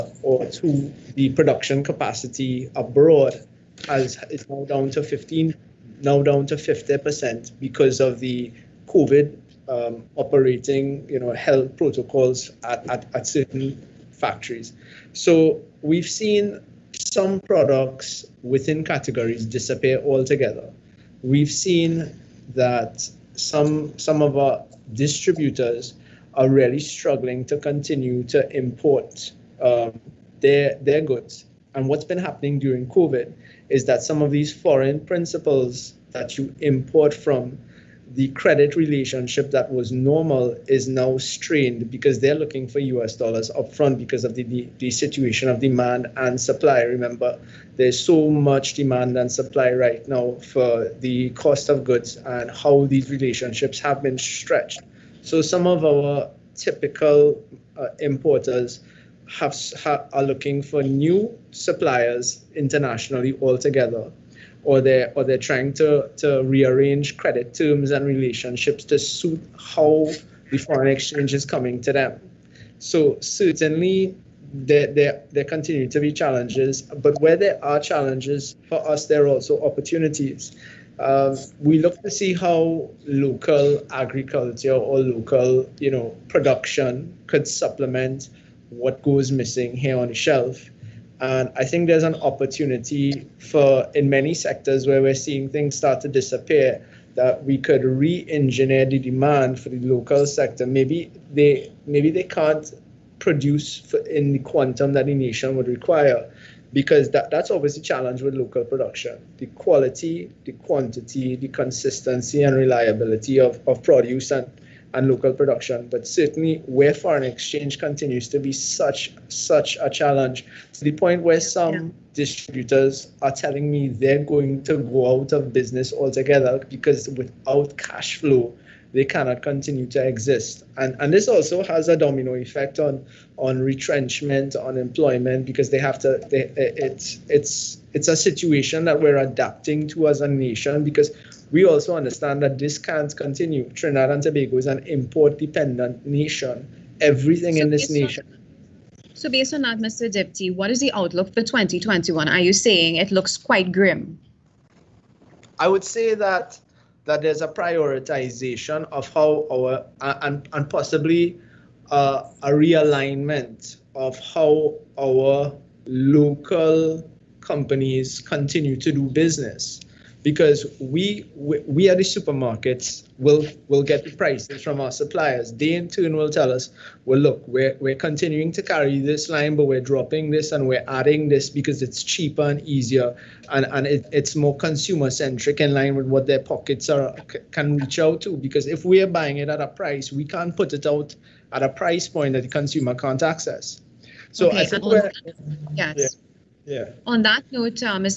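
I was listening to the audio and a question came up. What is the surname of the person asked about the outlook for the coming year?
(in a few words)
Diptee.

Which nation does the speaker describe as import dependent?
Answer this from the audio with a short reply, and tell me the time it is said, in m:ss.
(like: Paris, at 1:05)
Trinidad and Tobago, at 2:23.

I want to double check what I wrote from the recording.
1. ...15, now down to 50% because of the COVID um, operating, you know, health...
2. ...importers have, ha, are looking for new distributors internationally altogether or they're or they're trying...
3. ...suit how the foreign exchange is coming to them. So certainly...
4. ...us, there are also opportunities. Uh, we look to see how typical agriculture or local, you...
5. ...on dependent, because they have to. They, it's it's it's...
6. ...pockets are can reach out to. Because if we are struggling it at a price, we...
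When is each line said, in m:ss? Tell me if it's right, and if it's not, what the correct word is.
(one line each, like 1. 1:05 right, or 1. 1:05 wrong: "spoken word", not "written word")
1. 0:05 right
2. 0:58 wrong: "suppliers", not "distributors"
3. 1:08 right
4. 1:18 wrong: "local", not "typical"
5. 2:14 wrong: "employment", not "dependent"
6. 3:06 wrong: "buying", not "struggling".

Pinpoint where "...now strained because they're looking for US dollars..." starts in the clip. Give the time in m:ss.
0:40.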